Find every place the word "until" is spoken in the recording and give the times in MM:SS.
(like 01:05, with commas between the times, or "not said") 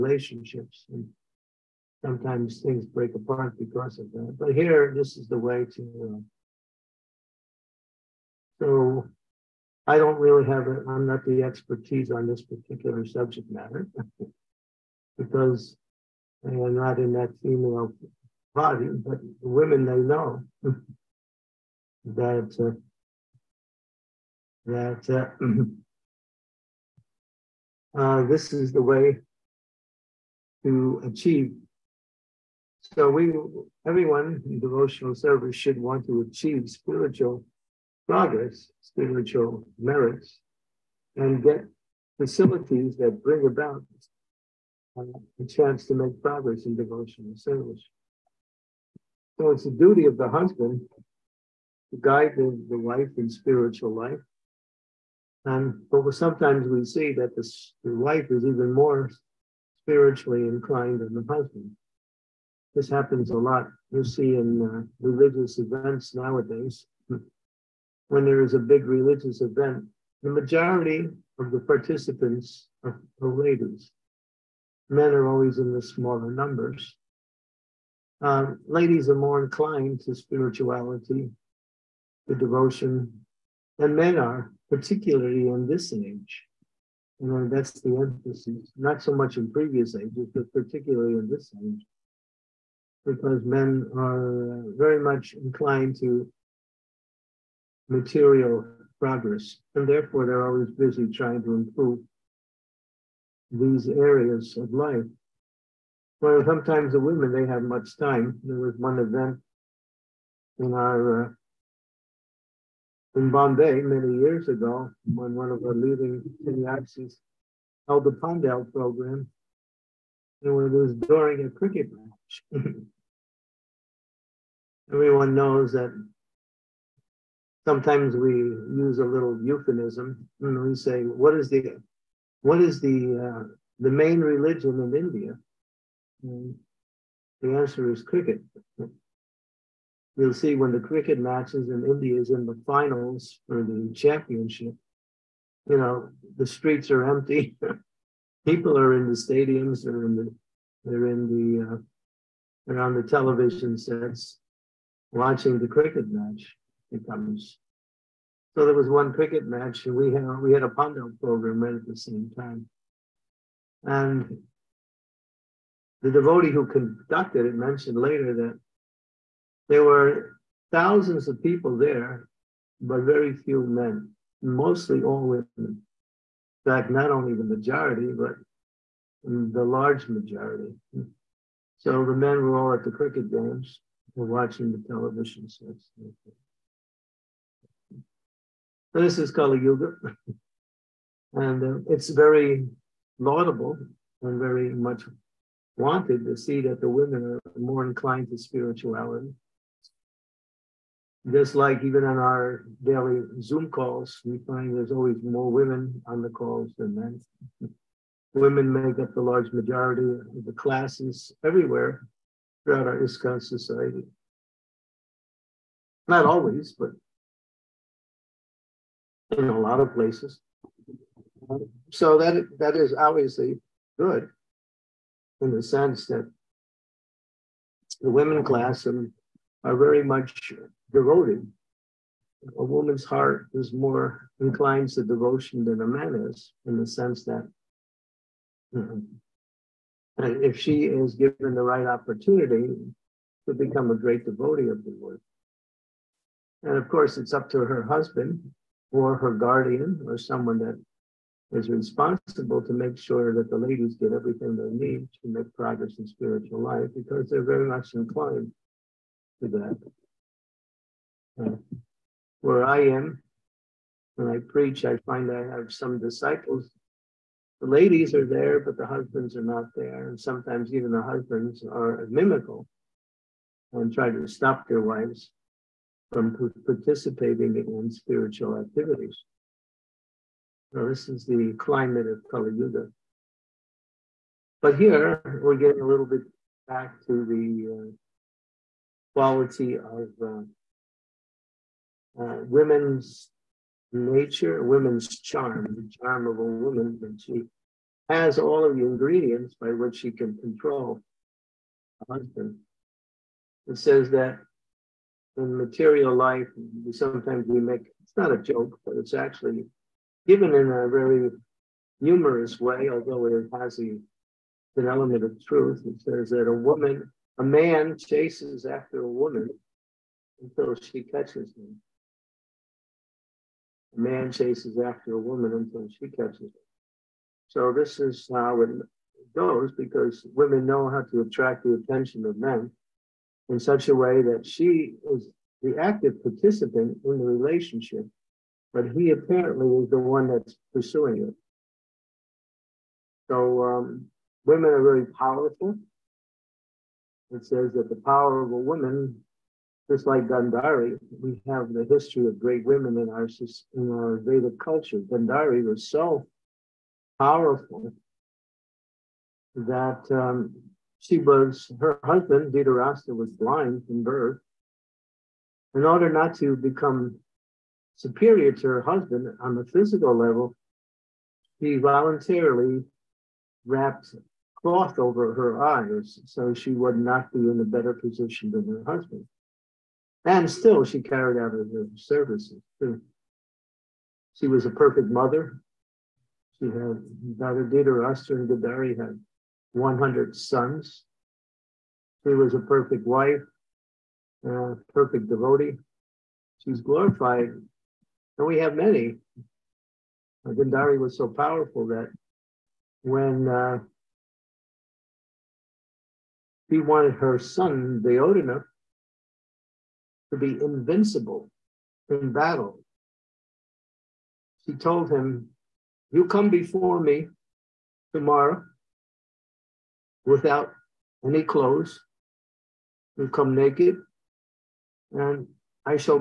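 05:20, 05:25.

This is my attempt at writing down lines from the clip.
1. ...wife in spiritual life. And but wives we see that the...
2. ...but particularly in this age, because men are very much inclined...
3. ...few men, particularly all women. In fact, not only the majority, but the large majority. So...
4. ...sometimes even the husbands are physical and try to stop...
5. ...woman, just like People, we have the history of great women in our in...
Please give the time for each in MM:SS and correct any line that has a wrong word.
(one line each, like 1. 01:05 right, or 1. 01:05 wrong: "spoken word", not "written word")
1. 00:52 wrong: "sometimes", not "wives"
2. 01:30 right
3. 02:53 wrong: "mostly", not "particularly"
4. 04:30 wrong: "mimical", not "physical"
5. 05:48 wrong: "Gandhari", not "People".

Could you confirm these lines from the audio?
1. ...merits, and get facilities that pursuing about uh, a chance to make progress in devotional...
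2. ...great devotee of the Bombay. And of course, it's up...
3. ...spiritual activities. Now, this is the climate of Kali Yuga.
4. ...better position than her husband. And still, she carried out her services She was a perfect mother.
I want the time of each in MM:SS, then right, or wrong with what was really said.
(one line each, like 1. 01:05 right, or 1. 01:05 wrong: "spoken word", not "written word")
1. 00:39 wrong: "bring", not "pursuing"
2. 04:03 wrong: "Lord", not "Bombay"
3. 04:37 right
4. 06:17 right.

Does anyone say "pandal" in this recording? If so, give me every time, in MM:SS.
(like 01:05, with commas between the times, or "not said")
01:58, 02:40.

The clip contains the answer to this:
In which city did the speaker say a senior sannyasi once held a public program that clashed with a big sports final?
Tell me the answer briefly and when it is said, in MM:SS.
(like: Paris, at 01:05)
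Bombay, at 01:53.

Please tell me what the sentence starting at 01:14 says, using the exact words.
Men are always in the smaller numbers.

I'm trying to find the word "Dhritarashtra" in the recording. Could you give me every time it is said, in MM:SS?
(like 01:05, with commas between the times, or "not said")
06:02, 06:27.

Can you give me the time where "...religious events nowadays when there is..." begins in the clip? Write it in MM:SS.
01:05.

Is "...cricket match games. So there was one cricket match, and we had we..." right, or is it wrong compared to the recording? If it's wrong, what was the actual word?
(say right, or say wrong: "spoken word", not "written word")
wrong: "becomes", not "games".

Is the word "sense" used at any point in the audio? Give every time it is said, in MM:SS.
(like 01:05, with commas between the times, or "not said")
03:45, 03:56.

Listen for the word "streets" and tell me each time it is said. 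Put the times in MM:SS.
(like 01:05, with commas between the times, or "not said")
02:26.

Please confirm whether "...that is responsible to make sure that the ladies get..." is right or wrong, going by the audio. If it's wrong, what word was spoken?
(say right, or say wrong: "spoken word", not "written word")
right.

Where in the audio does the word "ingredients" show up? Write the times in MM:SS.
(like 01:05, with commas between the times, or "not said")
04:58.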